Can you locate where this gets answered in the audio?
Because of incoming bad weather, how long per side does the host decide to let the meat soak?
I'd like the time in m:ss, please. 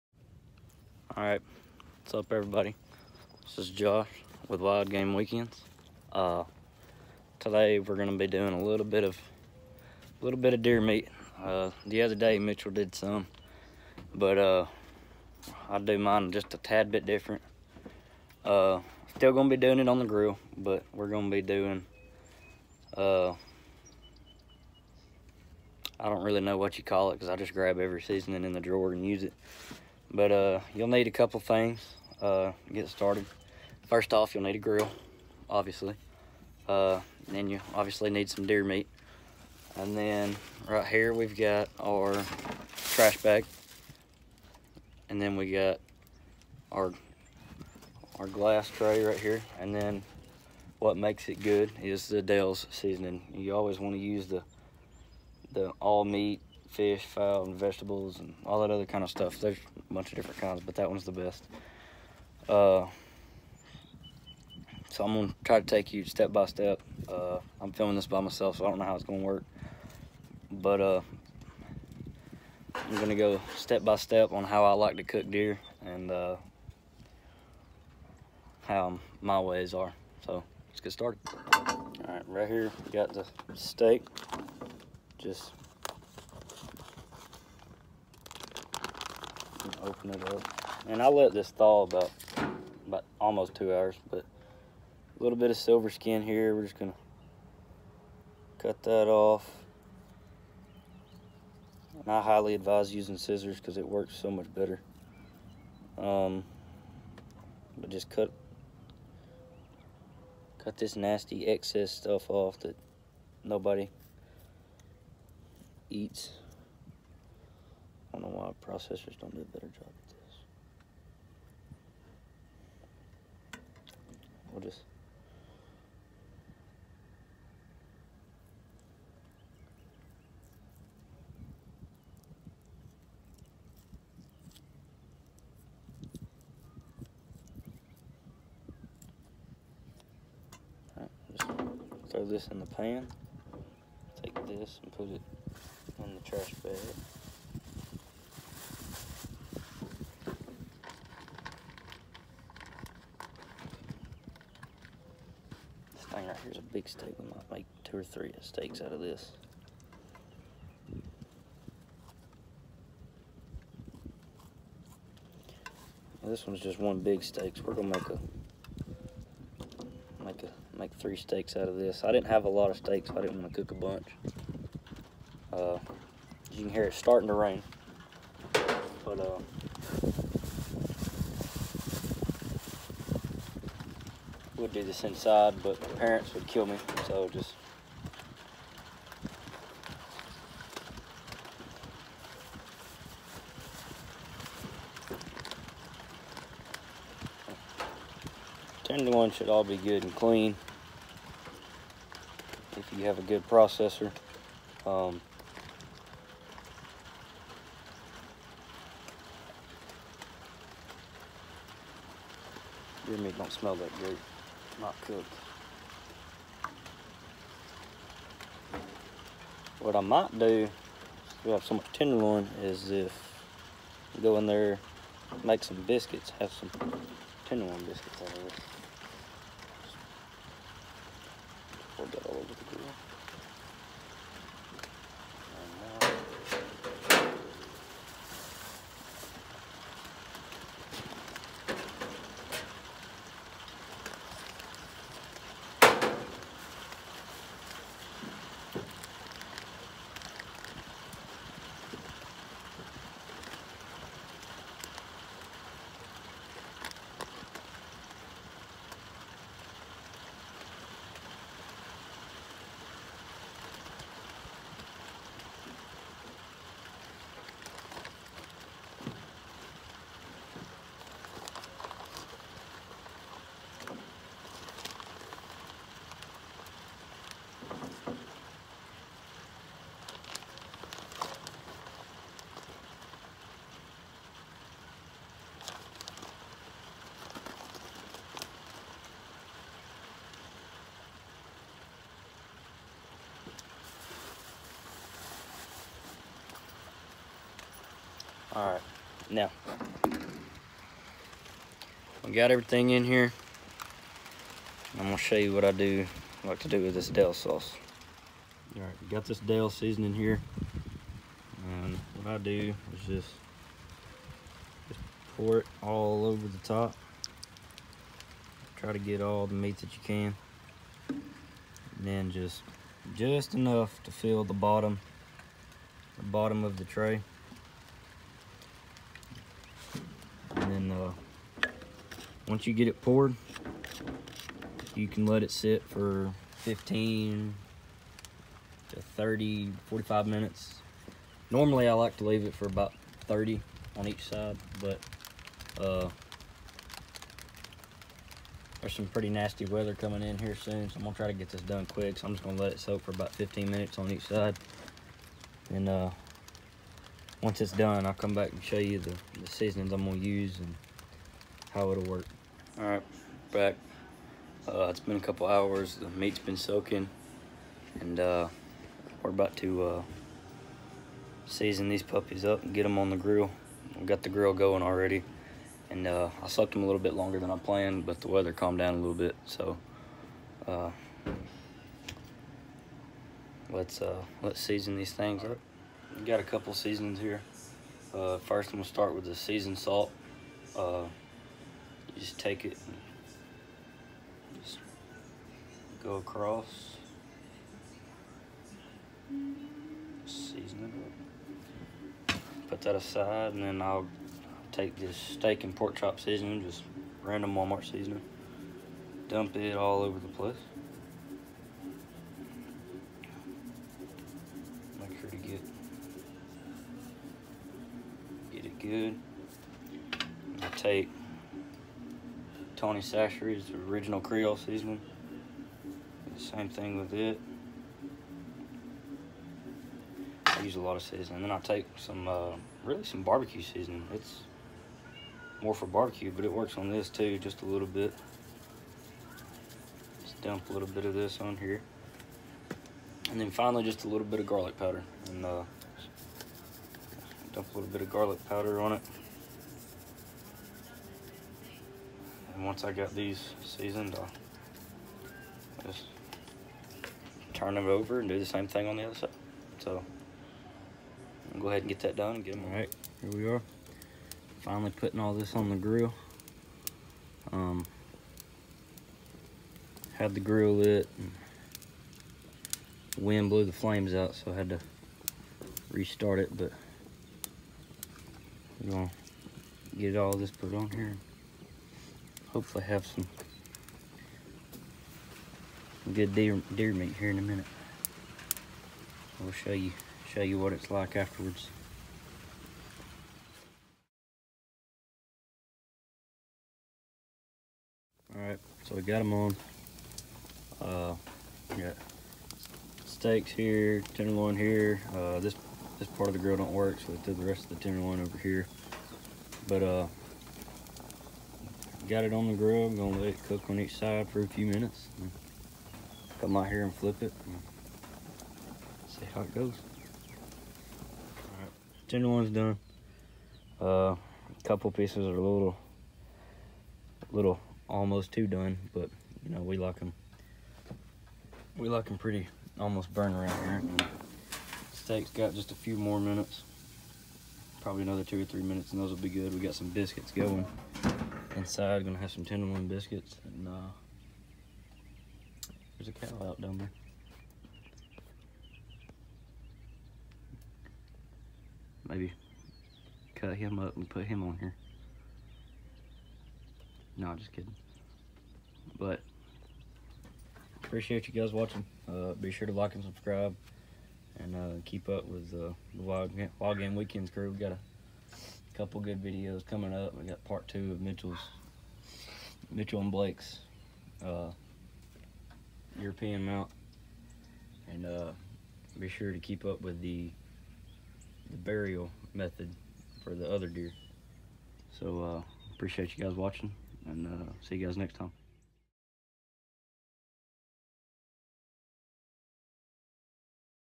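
5:53.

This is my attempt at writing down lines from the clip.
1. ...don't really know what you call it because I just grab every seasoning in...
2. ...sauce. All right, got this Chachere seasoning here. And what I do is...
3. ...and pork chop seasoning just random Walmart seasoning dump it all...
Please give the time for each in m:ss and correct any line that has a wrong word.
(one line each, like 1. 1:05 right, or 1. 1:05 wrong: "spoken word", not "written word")
1. 0:26 right
2. 5:07 wrong: "Dale", not "Chachere"
3. 6:45 right.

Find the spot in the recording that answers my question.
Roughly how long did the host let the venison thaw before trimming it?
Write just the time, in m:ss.
1:33.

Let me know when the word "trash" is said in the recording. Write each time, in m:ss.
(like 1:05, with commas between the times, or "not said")
0:42, 2:26.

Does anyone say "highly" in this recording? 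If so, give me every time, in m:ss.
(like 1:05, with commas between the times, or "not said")
1:42.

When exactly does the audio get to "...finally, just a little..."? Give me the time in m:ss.
7:23.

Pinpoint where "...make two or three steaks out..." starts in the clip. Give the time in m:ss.
2:37.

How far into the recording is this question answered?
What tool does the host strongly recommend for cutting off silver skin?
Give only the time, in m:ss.
1:43.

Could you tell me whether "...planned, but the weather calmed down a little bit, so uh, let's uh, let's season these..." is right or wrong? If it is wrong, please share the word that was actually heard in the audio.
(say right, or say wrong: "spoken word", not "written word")
right.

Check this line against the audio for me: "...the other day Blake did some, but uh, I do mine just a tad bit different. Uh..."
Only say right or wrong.
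wrong.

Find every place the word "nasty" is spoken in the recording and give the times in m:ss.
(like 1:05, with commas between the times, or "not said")
1:50, 5:49.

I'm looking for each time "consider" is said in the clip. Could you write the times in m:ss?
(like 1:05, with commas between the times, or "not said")
not said.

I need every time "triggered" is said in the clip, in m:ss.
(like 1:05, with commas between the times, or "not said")
not said.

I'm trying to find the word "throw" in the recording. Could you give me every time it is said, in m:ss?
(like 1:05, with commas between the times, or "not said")
2:22.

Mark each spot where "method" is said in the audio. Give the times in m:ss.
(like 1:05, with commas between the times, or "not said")
9:42.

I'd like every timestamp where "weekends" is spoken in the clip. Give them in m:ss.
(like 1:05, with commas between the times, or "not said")
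0:05, 9:26.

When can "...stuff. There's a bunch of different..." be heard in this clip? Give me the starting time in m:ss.
0:59.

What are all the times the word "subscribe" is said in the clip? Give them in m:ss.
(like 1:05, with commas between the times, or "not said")
9:23.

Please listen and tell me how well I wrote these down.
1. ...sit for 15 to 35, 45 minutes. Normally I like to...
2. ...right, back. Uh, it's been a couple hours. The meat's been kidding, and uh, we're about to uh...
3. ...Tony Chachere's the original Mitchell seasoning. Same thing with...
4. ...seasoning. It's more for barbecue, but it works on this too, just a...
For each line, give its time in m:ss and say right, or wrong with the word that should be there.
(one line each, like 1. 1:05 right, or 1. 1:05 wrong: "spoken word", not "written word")
1. 5:35 wrong: "30", not "35"
2. 6:02 wrong: "soaking", not "kidding"
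3. 7:02 wrong: "Creole", not "Mitchell"
4. 7:13 right.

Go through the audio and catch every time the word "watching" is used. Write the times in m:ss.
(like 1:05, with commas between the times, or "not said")
9:21, 9:46.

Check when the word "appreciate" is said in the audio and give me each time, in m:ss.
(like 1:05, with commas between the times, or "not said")
9:20, 9:45.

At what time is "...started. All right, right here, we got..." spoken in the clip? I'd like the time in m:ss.
1:20.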